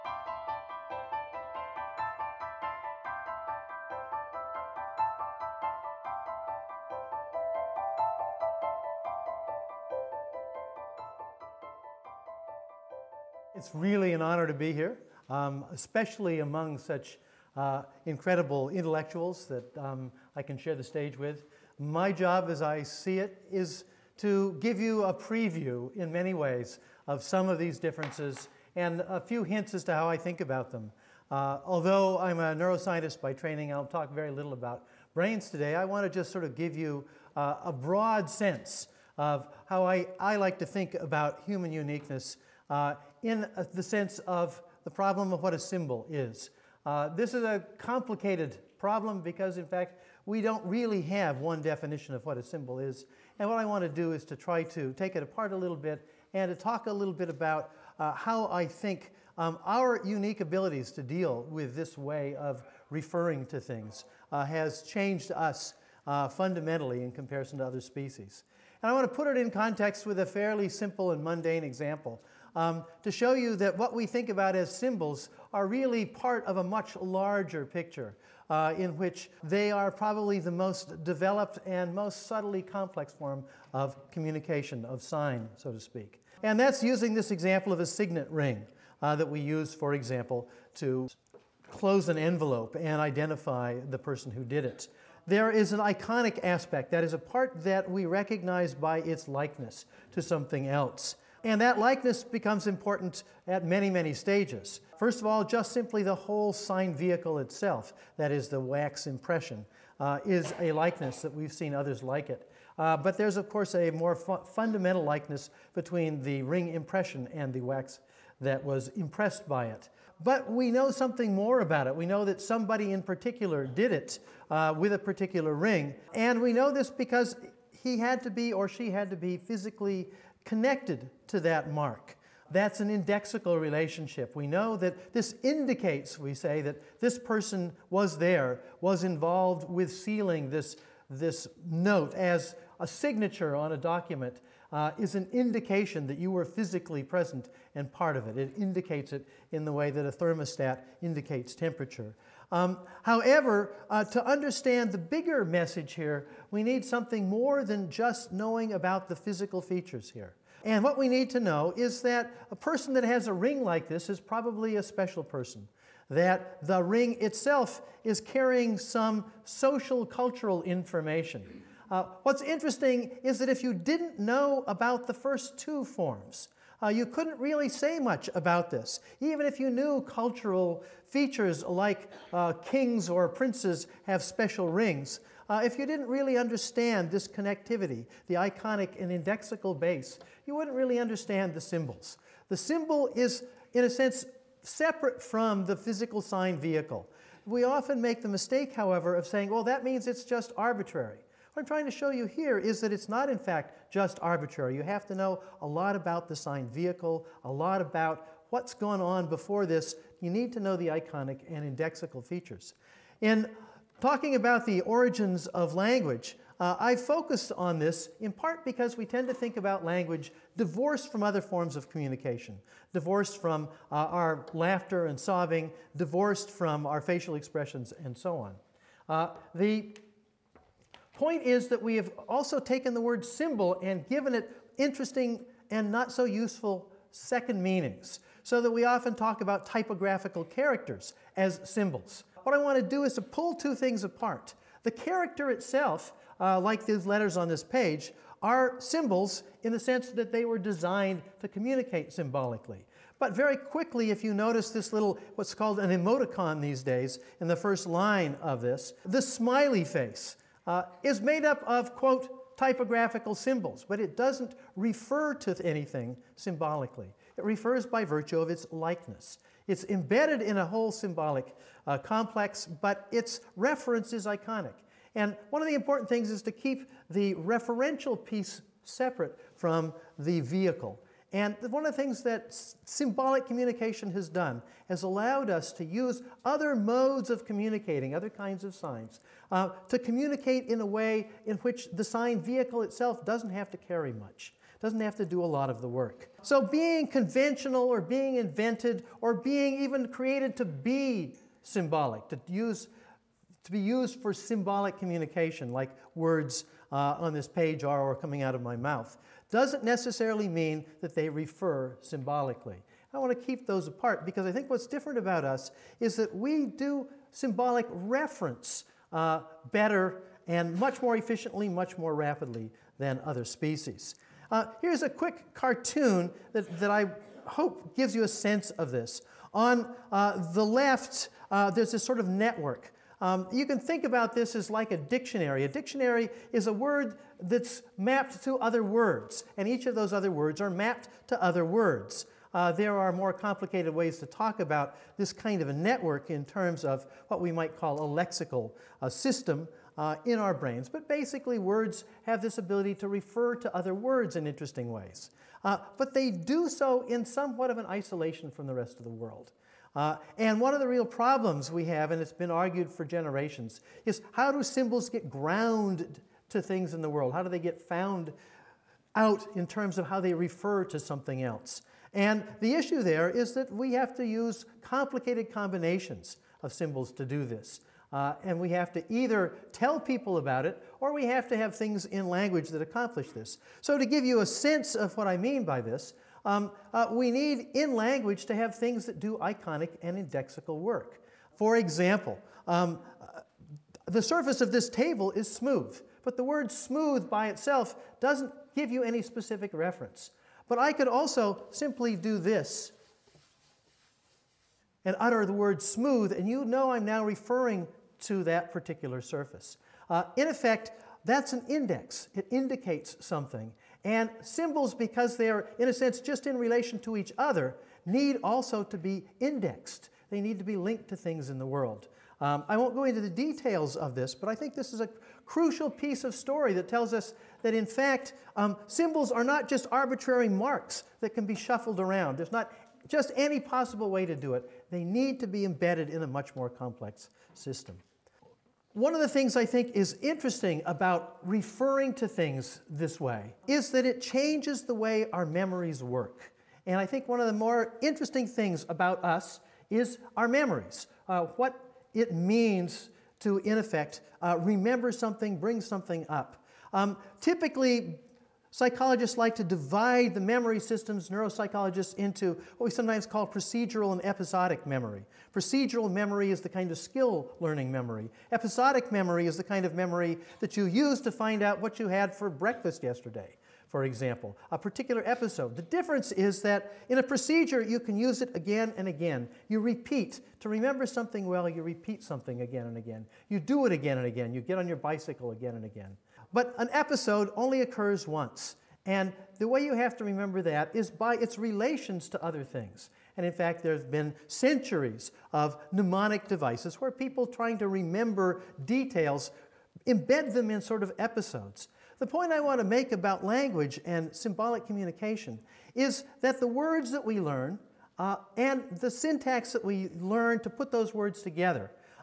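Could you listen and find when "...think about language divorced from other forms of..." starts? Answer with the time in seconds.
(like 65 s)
219 s.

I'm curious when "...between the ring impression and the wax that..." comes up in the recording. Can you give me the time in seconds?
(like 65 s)
115 s.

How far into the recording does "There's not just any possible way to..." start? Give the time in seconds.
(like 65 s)
432 s.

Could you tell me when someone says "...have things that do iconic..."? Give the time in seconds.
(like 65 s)
388 s.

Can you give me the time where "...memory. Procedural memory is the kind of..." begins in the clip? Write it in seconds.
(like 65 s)
464 s.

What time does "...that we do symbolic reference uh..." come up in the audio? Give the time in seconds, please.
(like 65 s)
316 s.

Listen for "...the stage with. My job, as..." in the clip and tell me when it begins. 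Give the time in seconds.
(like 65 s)
20 s.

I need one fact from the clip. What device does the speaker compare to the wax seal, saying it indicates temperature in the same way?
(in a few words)
thermostat.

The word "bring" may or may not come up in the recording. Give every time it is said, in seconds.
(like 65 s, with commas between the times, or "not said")
455 s.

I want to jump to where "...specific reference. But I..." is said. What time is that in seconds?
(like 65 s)
399 s.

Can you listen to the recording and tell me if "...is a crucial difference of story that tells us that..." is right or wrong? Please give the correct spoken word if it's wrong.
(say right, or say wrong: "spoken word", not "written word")
wrong: "piece", not "difference".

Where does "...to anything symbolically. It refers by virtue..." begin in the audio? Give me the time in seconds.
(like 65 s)
265 s.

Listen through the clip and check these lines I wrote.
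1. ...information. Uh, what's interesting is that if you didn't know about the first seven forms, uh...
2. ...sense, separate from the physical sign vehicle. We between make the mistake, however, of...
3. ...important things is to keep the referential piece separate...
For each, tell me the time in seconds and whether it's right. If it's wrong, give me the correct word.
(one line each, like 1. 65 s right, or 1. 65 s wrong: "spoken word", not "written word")
1. 170 s wrong: "two", not "seven"
2. 193 s wrong: "often", not "between"
3. 275 s right.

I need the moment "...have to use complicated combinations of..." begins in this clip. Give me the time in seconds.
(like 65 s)
373 s.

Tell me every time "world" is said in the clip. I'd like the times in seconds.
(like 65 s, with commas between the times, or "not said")
359 s, 367 s, 421 s.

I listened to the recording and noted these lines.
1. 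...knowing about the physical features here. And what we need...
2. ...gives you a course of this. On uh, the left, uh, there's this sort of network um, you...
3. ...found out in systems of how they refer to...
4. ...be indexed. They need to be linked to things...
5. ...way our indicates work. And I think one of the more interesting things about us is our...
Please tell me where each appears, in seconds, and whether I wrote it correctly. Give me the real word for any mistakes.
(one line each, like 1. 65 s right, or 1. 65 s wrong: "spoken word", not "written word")
1. 158 s right
2. 327 s wrong: "sense", not "course"
3. 367 s wrong: "terms", not "systems"
4. 418 s right
5. 444 s wrong: "memories", not "indicates".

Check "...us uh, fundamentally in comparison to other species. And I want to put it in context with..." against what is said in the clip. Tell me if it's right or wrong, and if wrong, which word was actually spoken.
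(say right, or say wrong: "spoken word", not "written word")
right.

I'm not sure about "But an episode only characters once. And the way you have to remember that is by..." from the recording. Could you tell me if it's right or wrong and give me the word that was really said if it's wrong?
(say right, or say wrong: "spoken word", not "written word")
wrong: "occurs", not "characters".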